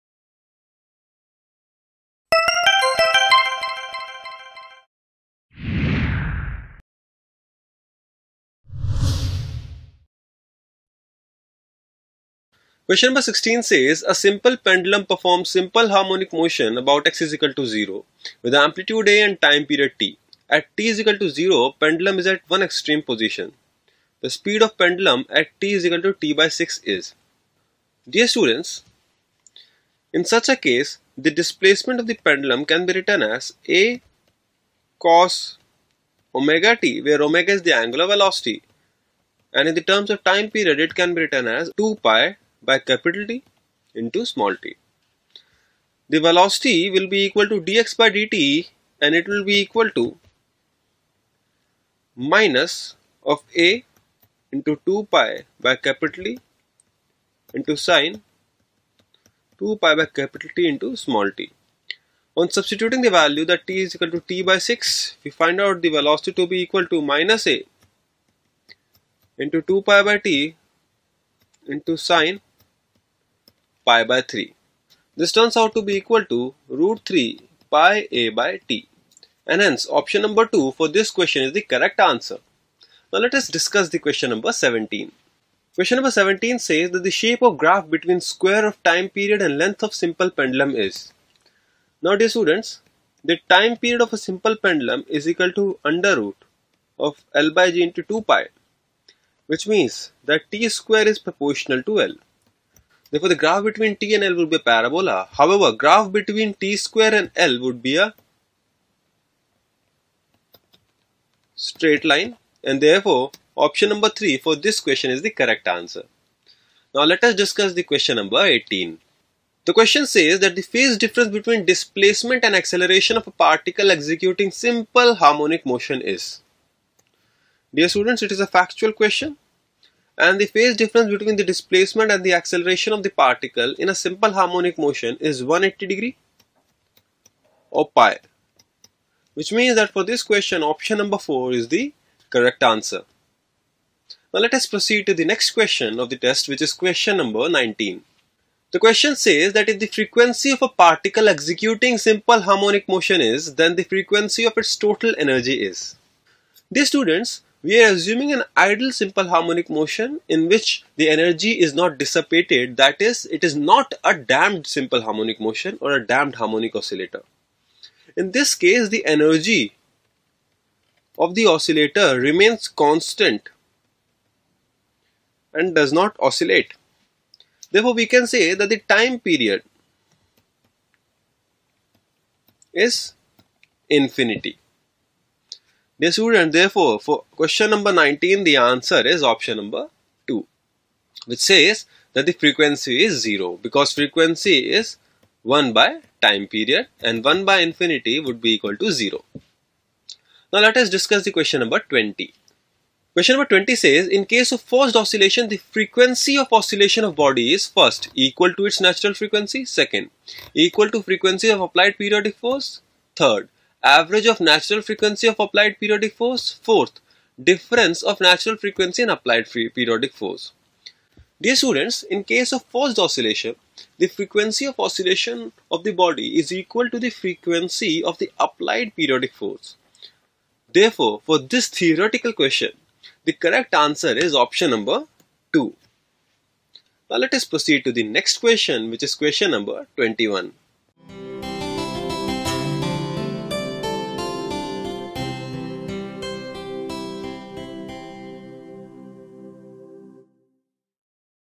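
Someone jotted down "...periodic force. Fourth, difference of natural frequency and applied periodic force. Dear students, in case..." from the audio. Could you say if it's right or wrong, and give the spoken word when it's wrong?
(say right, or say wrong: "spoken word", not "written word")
right.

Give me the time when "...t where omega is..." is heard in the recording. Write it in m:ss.
0:36.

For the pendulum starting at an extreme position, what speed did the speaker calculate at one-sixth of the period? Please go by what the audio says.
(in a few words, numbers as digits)
root 3 pi a by T.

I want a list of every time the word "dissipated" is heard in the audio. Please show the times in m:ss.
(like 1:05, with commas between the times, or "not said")
2:41.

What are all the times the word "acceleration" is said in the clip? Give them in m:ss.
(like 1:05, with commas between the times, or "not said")
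2:02, 2:12.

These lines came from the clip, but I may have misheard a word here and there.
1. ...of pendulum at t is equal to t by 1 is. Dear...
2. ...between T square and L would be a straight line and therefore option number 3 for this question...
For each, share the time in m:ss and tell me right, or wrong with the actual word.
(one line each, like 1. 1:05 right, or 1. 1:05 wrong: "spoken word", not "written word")
1. 0:24 wrong: "6", not "1"
2. 1:46 right.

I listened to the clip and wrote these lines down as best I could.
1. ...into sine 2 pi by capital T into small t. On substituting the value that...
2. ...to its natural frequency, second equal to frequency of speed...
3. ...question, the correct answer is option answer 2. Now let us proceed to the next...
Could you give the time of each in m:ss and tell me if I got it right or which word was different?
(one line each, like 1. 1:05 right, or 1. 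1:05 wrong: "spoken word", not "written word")
1. 0:57 right
2. 3:28 wrong: "applied", not "speed"
3. 3:52 wrong: "number", not "answer".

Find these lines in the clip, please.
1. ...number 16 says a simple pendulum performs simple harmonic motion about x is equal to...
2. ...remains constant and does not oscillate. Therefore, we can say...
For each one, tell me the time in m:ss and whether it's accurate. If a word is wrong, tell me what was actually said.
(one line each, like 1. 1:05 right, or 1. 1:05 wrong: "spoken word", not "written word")
1. 0:13 right
2. 2:52 right.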